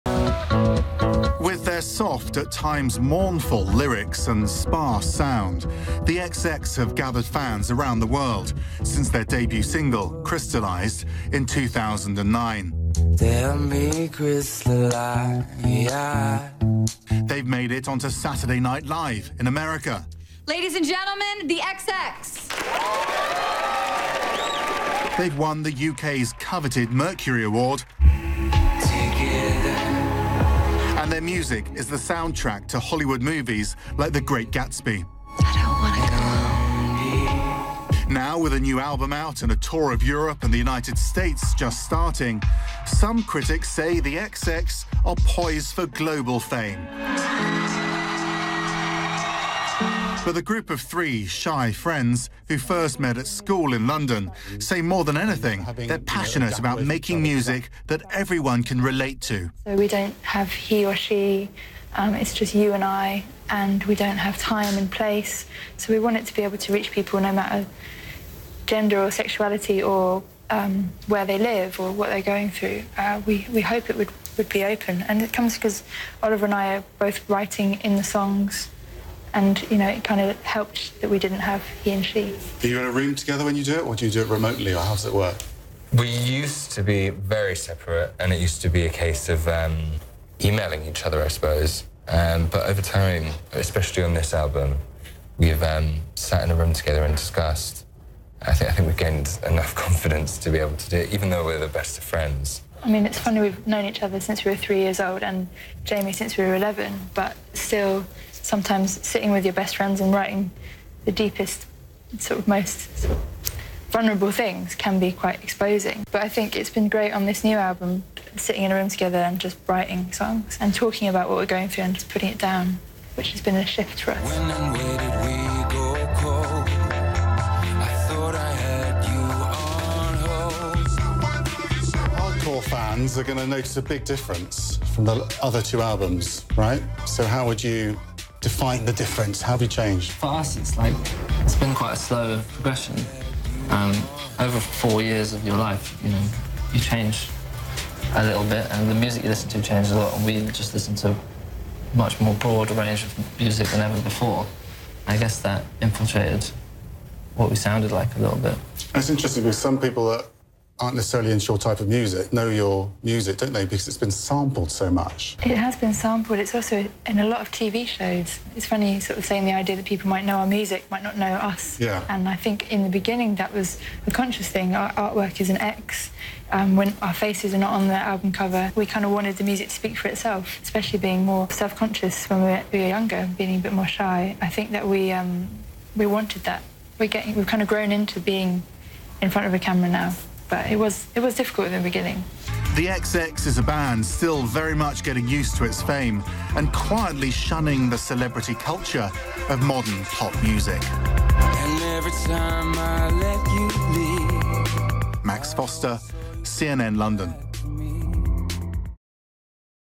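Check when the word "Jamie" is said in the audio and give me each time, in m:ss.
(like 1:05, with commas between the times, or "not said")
1:45.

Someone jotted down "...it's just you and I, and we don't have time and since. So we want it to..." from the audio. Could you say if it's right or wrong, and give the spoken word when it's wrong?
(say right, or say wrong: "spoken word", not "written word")
wrong: "place", not "since".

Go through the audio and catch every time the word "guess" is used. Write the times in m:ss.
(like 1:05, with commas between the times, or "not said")
2:35.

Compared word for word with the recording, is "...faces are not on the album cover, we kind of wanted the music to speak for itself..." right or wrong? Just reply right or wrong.
right.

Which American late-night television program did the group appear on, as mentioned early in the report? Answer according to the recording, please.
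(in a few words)
Saturday Night Live.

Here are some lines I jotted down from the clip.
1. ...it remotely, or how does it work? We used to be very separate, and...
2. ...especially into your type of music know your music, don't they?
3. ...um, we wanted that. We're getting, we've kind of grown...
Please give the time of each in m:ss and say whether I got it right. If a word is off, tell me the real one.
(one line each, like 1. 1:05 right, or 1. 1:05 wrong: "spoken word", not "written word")
1. 1:24 right
2. 2:40 wrong: "necessarily", not "especially"
3. 3:05 right.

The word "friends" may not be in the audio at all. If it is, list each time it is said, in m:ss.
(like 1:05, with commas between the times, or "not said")
0:51, 1:42, 1:49.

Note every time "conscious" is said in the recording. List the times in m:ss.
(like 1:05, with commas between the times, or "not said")
2:54, 3:01.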